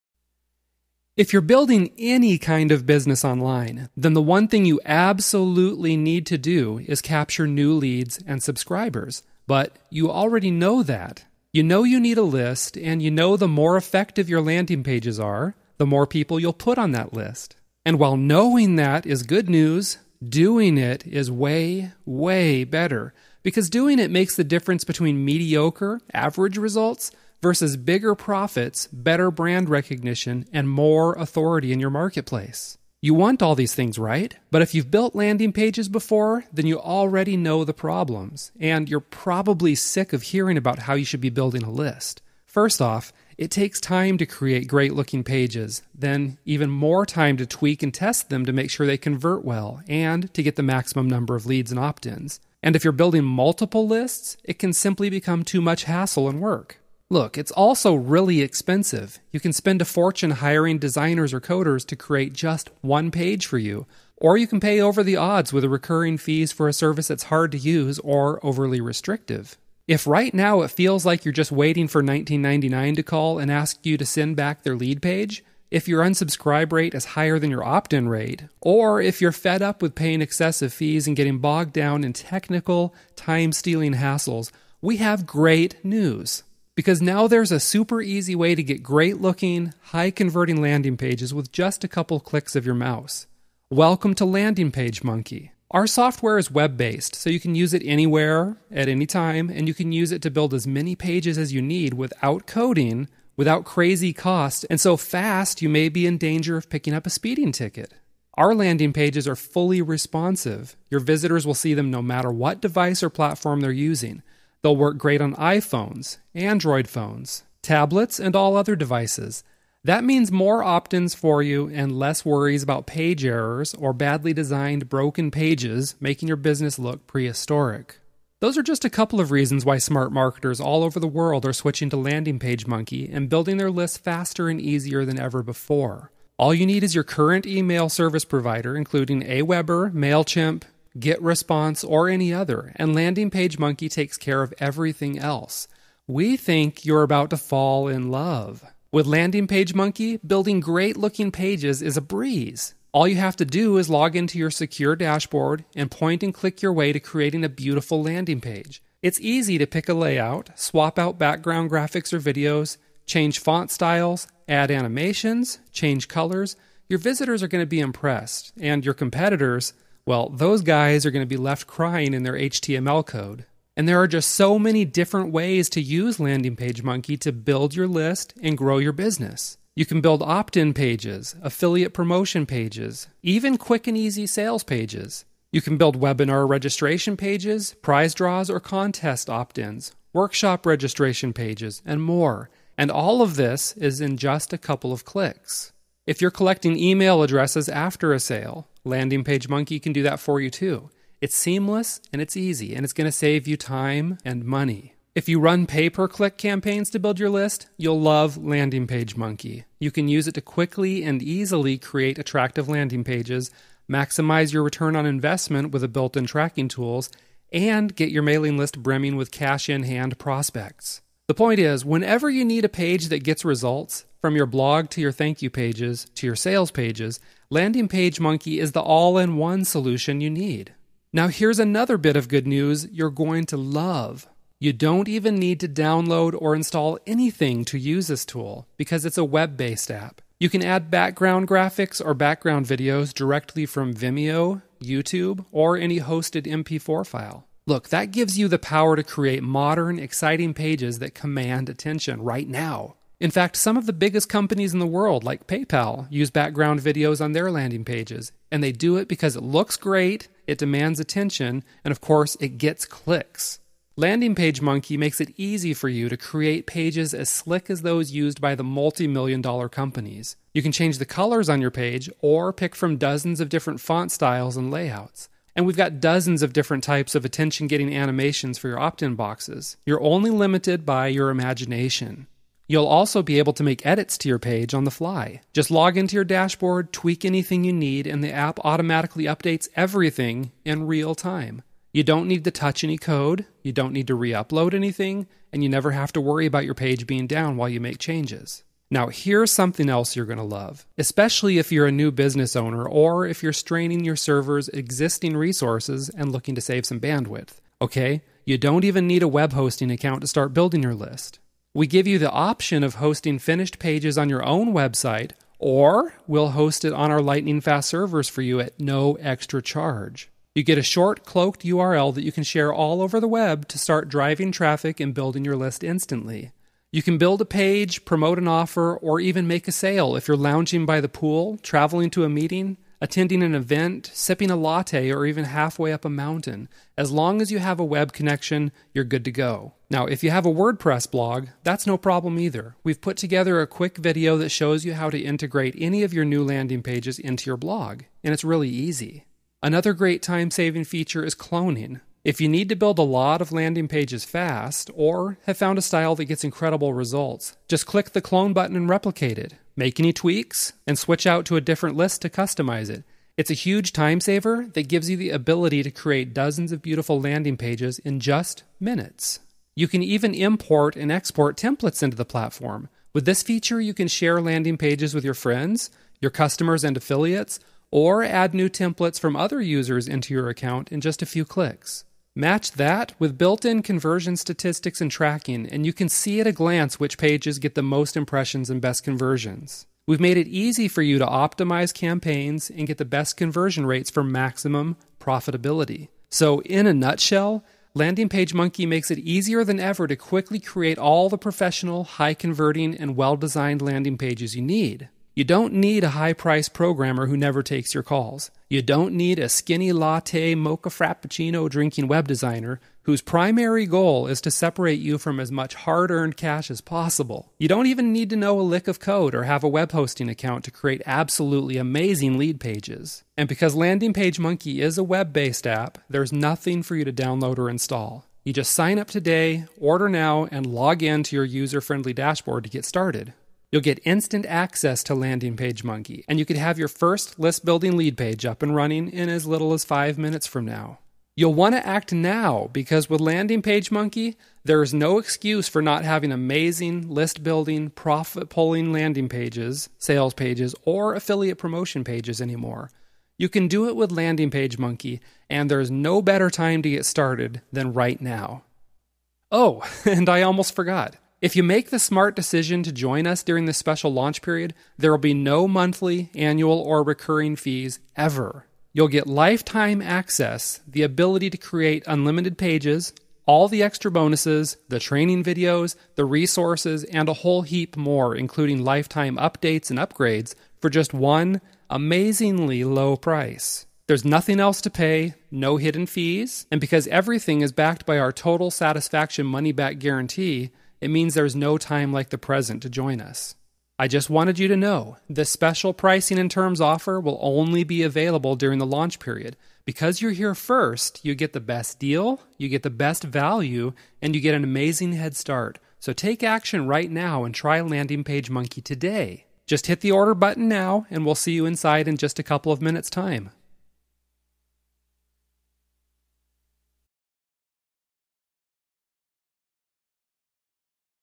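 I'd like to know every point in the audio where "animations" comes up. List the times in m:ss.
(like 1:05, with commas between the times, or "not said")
2:44, 4:37.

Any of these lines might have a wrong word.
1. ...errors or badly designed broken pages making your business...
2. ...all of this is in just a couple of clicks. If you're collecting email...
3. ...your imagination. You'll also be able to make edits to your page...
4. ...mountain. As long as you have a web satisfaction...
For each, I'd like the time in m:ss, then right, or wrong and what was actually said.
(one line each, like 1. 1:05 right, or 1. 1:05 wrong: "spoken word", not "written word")
1. 2:03 right
2. 3:12 right
3. 4:41 right
4. 5:36 wrong: "connection", not "satisfaction".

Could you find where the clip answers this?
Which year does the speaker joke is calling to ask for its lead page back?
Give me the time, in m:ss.
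1:11.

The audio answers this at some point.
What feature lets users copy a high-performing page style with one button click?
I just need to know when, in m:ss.
5:51.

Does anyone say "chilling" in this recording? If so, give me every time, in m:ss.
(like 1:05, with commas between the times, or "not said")
not said.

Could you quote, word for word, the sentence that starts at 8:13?
I just wanted you to know the special pricing and terms offer will only be available during the launch period.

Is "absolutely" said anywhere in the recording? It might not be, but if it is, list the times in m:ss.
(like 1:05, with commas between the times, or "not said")
0:04, 7:01.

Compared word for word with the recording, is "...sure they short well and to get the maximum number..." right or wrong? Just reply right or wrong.
wrong.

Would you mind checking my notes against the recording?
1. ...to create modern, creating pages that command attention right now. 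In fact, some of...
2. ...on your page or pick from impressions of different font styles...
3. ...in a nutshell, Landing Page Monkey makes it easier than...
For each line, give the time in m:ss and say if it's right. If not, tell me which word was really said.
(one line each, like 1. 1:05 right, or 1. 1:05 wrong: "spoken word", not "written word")
1. 4:08 wrong: "exciting", not "creating"
2. 4:31 wrong: "dozens", not "impressions"
3. 6:36 right.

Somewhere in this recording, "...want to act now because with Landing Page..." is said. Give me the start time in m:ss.
7:21.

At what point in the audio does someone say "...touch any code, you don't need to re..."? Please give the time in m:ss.
4:52.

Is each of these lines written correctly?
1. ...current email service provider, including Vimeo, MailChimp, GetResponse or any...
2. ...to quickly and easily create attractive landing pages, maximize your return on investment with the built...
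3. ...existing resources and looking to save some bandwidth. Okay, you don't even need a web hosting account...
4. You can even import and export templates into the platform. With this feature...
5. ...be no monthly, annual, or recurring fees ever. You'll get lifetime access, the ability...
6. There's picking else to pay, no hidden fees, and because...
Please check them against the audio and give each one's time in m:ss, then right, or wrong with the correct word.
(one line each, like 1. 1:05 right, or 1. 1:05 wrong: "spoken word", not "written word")
1. 2:17 wrong: "Aweber", not "Vimeo"
2. 3:30 right
3. 5:04 right
4. 6:09 right
5. 7:45 right
6. 8:04 wrong: "nothing", not "picking".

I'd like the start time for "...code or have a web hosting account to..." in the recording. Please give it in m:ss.
6:58.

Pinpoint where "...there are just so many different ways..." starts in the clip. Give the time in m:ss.
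2:53.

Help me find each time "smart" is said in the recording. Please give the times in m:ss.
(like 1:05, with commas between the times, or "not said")
2:09, 7:41.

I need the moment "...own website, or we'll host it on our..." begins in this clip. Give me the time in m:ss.
5:14.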